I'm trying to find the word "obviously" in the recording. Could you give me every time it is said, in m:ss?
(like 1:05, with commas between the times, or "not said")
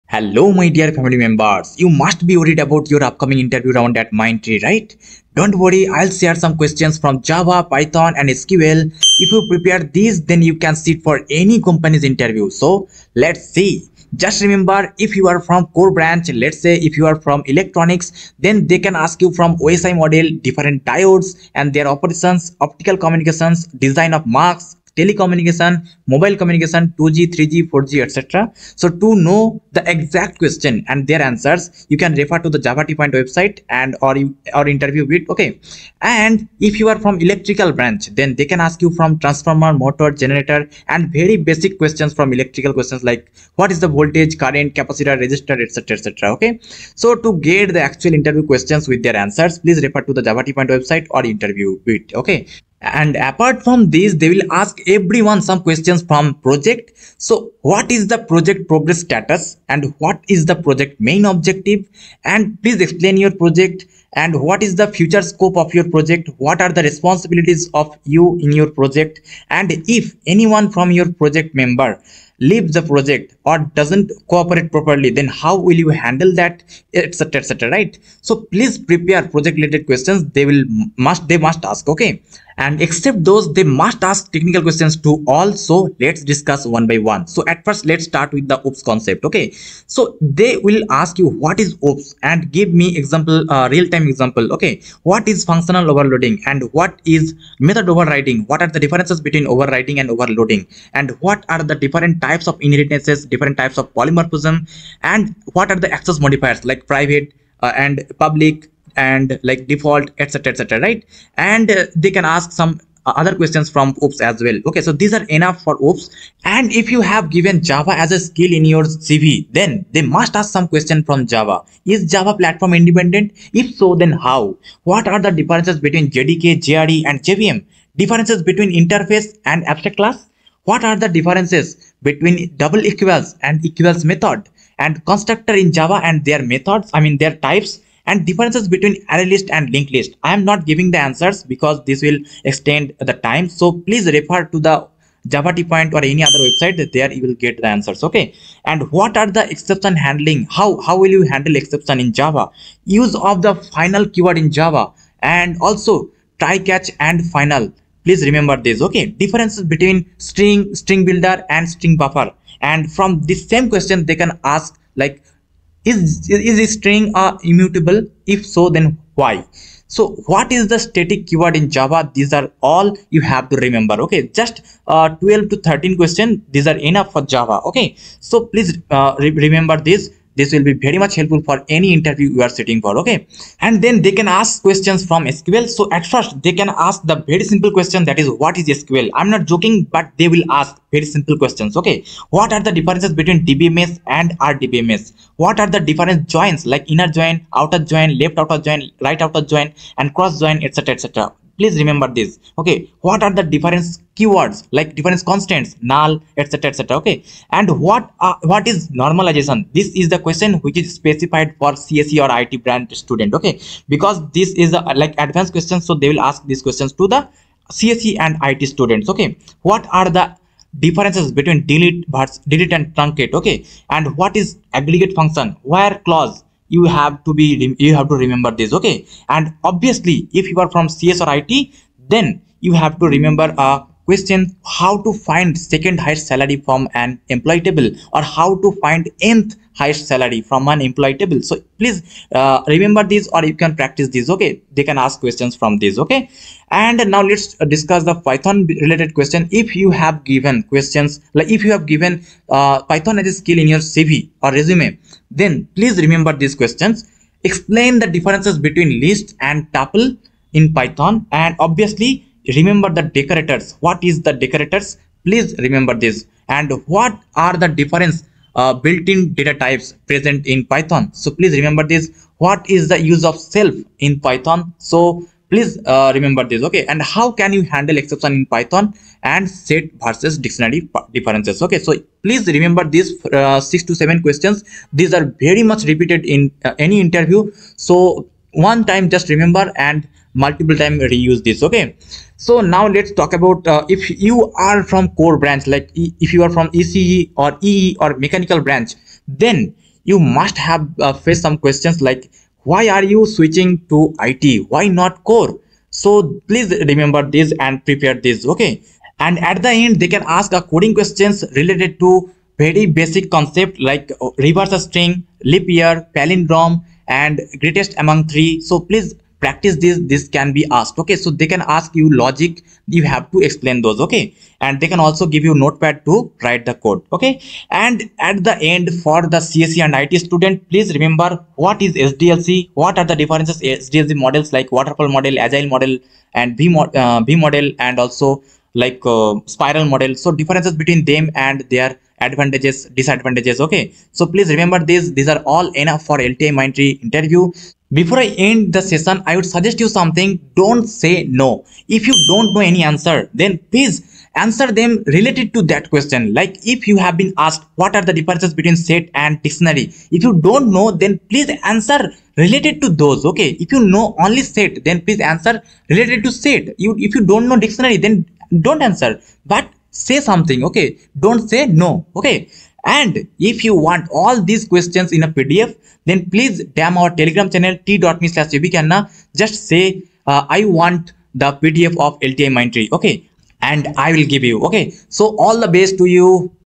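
3:49, 4:21.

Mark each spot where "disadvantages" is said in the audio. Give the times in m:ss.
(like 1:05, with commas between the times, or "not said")
5:42.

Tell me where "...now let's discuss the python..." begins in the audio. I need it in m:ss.
4:07.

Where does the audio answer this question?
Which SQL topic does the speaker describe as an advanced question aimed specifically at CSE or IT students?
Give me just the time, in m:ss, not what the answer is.
3:29.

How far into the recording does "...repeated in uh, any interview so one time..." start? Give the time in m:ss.
4:45.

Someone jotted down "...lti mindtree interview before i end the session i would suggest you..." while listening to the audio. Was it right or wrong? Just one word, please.
right.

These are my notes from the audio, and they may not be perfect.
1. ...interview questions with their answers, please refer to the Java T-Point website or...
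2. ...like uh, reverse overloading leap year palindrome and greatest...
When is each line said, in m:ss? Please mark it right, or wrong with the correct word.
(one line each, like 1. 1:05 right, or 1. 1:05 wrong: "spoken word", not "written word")
1. 0:48 right
2. 5:13 wrong: "string", not "overloading".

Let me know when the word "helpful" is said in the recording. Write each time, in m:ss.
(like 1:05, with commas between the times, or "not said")
3:01.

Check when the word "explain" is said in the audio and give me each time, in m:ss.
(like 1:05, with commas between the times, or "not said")
1:02, 4:17, 5:23.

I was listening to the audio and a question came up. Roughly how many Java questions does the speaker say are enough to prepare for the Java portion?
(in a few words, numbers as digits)
12 to 13.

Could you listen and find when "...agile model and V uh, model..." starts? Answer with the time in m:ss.
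5:35.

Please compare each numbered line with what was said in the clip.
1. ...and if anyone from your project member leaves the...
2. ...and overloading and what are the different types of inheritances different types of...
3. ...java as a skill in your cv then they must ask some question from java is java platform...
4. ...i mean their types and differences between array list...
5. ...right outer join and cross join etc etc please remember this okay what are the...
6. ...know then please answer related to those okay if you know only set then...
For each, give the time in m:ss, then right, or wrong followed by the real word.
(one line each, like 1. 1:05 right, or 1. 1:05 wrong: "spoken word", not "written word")
1. 1:09 right
2. 1:39 right
3. 1:57 right
4. 2:16 right
5. 3:19 right
6. 6:00 right.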